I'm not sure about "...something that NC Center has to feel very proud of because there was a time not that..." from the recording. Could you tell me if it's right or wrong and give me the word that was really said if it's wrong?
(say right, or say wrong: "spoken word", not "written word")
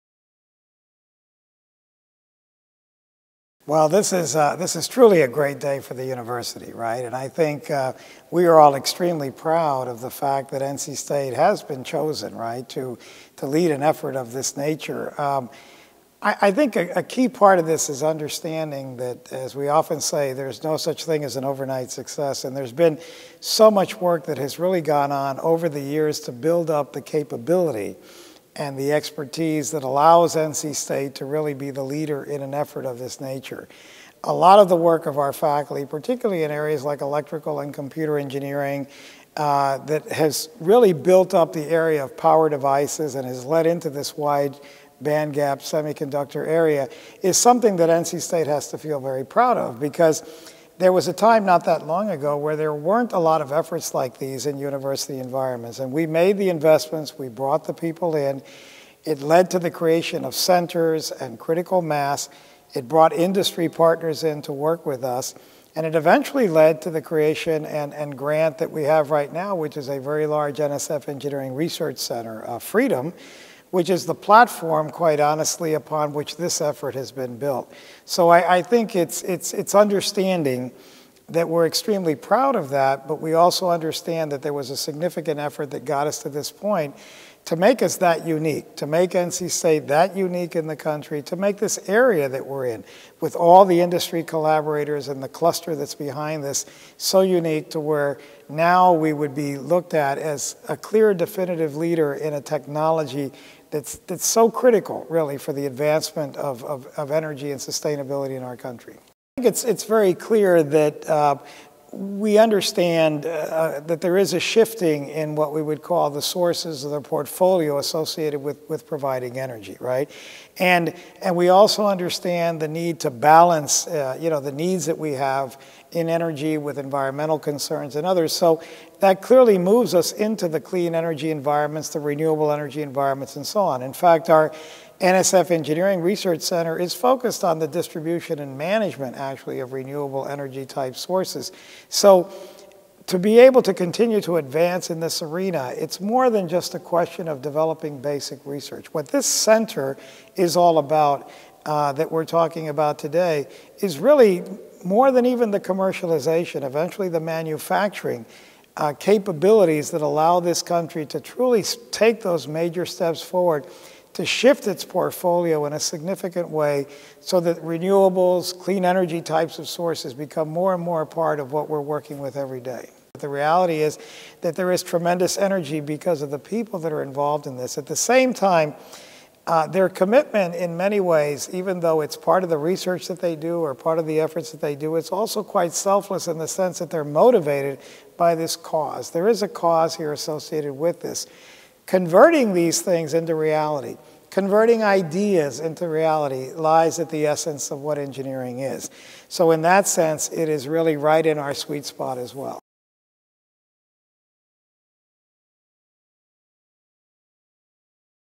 wrong: "State", not "Center".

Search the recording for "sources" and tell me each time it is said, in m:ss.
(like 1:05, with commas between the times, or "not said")
1:56, 2:20, 2:49.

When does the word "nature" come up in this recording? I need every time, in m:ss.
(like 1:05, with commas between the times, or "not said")
0:14, 0:33.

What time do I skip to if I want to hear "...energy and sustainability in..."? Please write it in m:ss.
1:47.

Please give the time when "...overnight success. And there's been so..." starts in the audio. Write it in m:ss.
0:21.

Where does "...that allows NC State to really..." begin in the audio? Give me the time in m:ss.
0:29.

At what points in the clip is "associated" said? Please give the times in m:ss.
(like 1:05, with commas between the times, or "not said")
1:57, 3:10.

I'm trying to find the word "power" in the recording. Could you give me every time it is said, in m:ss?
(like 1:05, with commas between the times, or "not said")
0:42.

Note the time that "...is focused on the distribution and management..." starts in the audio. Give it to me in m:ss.
2:16.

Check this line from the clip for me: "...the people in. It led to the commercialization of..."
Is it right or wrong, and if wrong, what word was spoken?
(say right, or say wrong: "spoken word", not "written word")
wrong: "creation", not "commercialization".